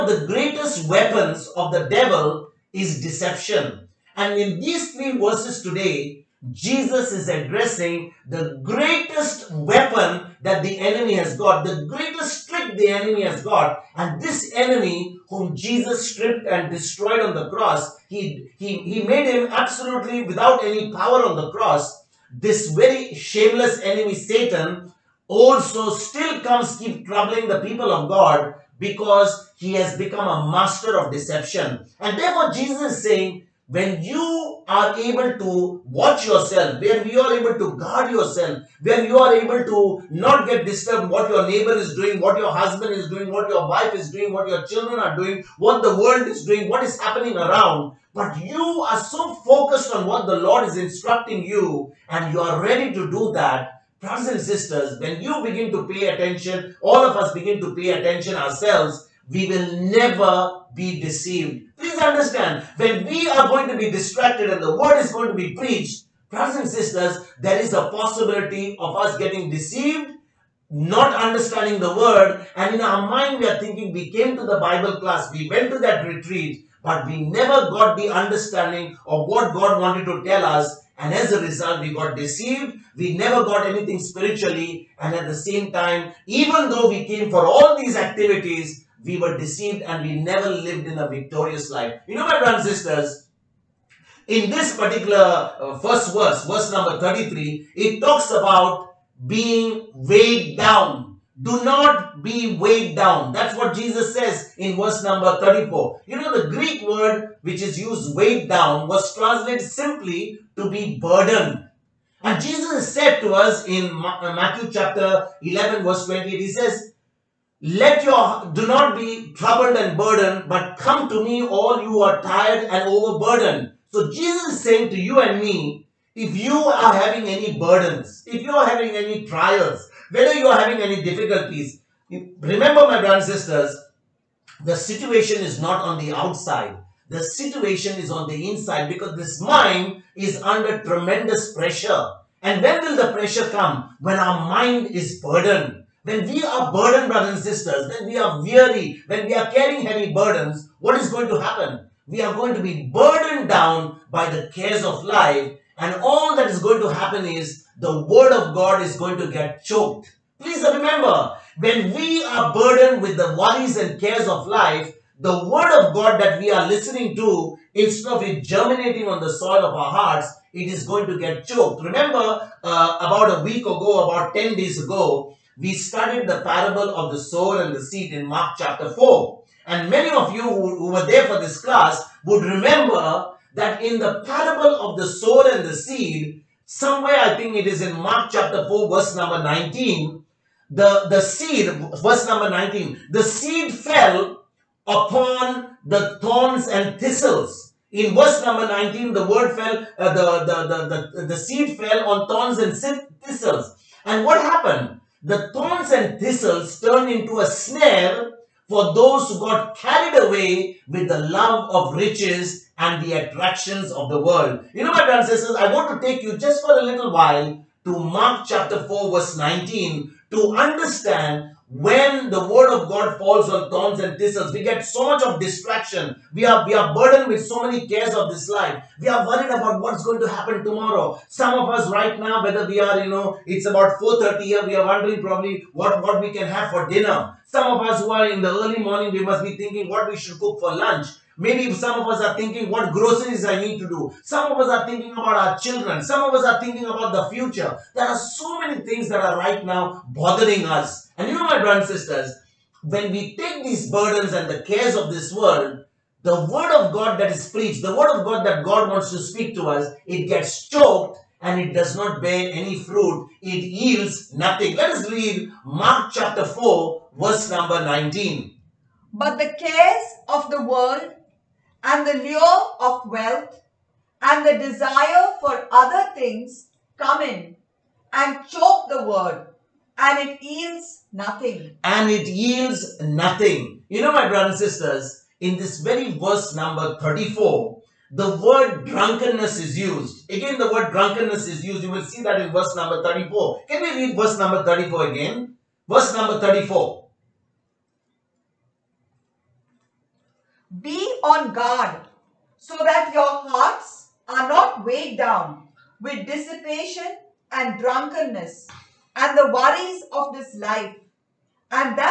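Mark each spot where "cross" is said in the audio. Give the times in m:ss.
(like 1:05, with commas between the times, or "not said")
0:17, 0:21.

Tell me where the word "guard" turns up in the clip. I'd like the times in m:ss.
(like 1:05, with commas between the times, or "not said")
0:37, 5:01.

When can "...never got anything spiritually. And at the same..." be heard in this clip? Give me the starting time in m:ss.
1:23.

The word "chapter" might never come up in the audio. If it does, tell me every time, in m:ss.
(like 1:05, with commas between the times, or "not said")
1:54, 2:58, 3:08, 3:38, 4:26.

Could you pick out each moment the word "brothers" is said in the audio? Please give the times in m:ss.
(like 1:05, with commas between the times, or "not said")
0:54, 1:06, 1:32, 2:13, 2:27, 3:35, 4:11, 4:44.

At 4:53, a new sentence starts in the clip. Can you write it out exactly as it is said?
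Can we read verse number 34 again?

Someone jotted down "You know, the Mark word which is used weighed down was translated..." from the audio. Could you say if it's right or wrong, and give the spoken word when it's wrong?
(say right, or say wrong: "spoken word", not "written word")
wrong: "Greek", not "Mark".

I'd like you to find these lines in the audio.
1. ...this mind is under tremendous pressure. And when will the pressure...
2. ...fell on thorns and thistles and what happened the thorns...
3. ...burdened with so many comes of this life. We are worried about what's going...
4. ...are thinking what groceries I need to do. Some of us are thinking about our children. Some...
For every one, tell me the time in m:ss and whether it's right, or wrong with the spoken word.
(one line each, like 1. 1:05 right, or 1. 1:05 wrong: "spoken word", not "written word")
1. 2:19 right
2. 3:21 right
3. 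3:46 wrong: "cares", not "comes"
4. 4:02 right.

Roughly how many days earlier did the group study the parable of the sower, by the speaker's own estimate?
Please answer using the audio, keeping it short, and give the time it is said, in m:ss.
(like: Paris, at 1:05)
10 days, at 2:54.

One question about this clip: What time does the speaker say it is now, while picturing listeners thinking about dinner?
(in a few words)
4:30.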